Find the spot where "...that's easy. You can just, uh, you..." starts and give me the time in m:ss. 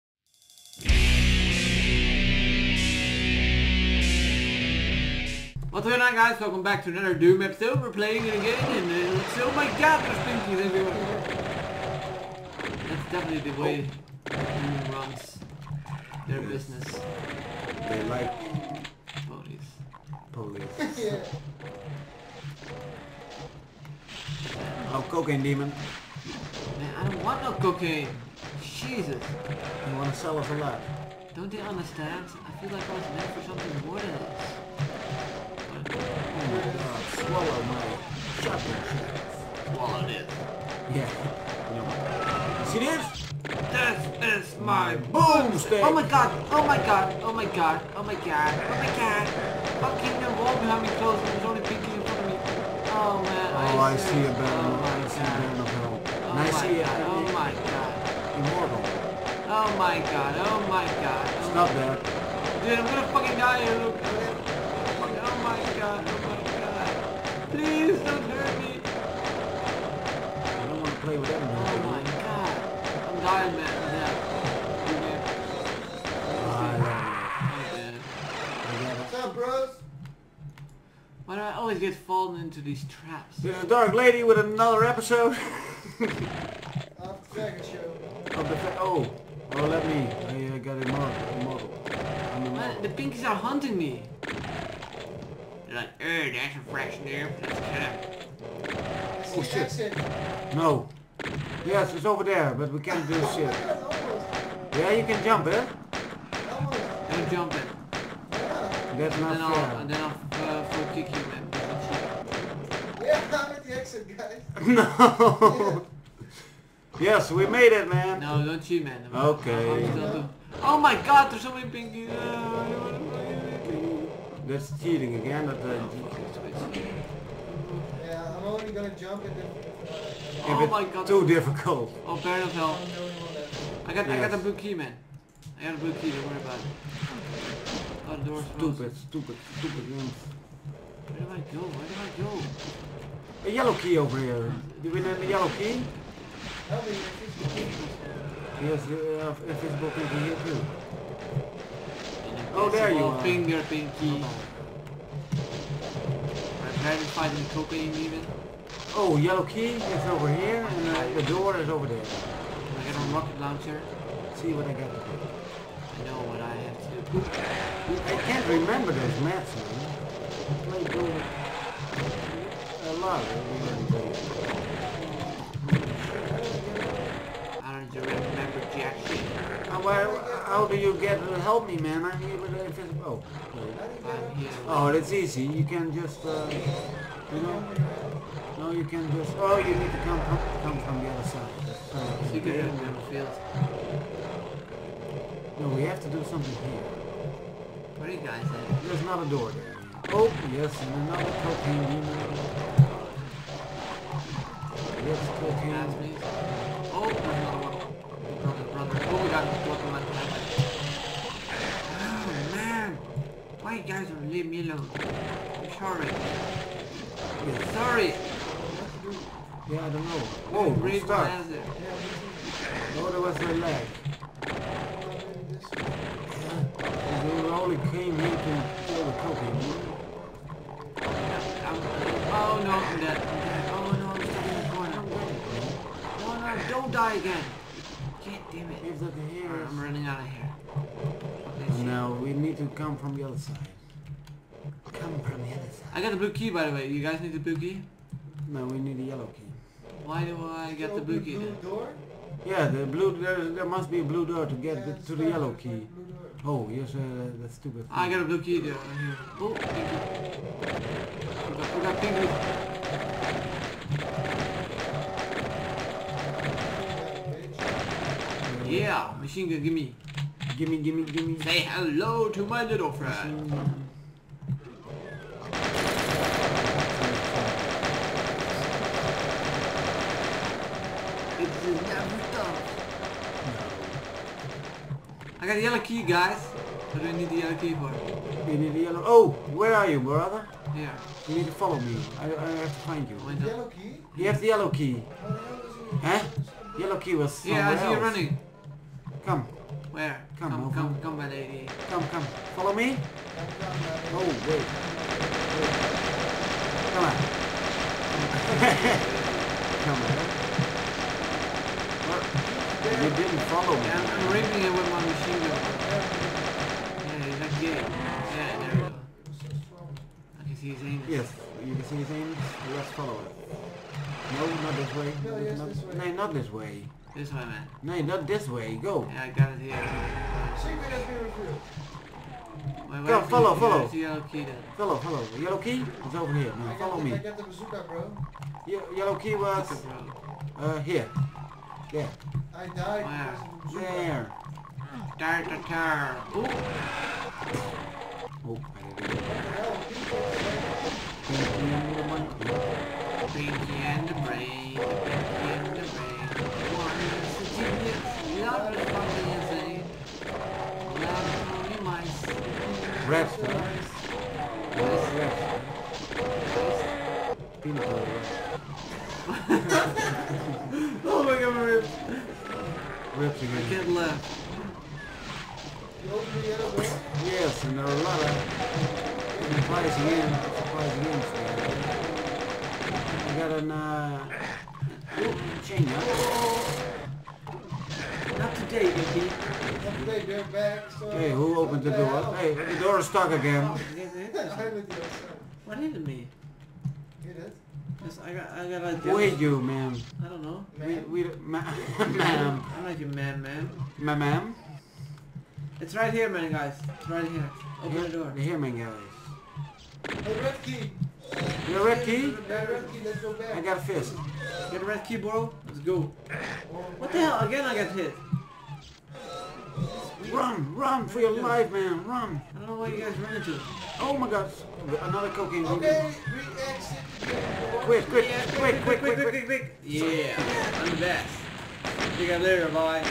3:04.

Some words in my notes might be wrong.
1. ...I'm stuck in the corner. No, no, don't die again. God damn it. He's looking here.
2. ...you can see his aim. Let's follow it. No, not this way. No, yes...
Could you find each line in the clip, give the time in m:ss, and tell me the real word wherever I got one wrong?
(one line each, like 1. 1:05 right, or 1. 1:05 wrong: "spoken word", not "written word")
1. 3:54 right
2. 5:21 right.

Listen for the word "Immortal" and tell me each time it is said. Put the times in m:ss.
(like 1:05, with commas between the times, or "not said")
0:58.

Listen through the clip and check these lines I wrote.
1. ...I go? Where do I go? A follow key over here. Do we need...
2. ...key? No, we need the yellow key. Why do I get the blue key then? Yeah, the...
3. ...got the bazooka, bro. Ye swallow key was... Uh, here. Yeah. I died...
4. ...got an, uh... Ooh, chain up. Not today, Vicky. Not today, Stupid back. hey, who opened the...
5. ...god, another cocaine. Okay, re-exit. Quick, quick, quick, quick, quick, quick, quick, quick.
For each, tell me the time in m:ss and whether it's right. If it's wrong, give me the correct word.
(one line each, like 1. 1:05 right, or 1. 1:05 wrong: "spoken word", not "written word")
1. 2:21 wrong: "yellow", not "follow"
2. 4:07 right
3. 5:37 wrong: "yellow", not "swallow"
4. 6:23 wrong: "Dirt", not "Stupid"
5. 7:04 right.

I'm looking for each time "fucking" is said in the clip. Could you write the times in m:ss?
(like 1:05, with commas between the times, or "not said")
0:49, 1:03.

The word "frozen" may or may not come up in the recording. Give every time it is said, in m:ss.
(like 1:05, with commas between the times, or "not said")
2:18.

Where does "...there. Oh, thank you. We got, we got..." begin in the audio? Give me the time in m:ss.
4:18.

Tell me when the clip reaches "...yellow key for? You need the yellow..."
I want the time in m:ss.
4:47.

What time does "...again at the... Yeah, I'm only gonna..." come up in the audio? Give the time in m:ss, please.
2:05.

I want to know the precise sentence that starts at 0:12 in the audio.
That's definitely the way Doom runs their yes.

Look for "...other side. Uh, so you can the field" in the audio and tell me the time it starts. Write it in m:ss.
3:11.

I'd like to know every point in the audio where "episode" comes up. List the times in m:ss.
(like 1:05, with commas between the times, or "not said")
0:07, 1:24.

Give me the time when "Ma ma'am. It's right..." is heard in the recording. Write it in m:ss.
6:43.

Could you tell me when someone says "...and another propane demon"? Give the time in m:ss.
3:20.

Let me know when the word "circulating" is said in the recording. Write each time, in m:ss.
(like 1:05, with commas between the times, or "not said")
not said.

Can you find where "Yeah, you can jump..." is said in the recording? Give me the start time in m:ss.
1:44.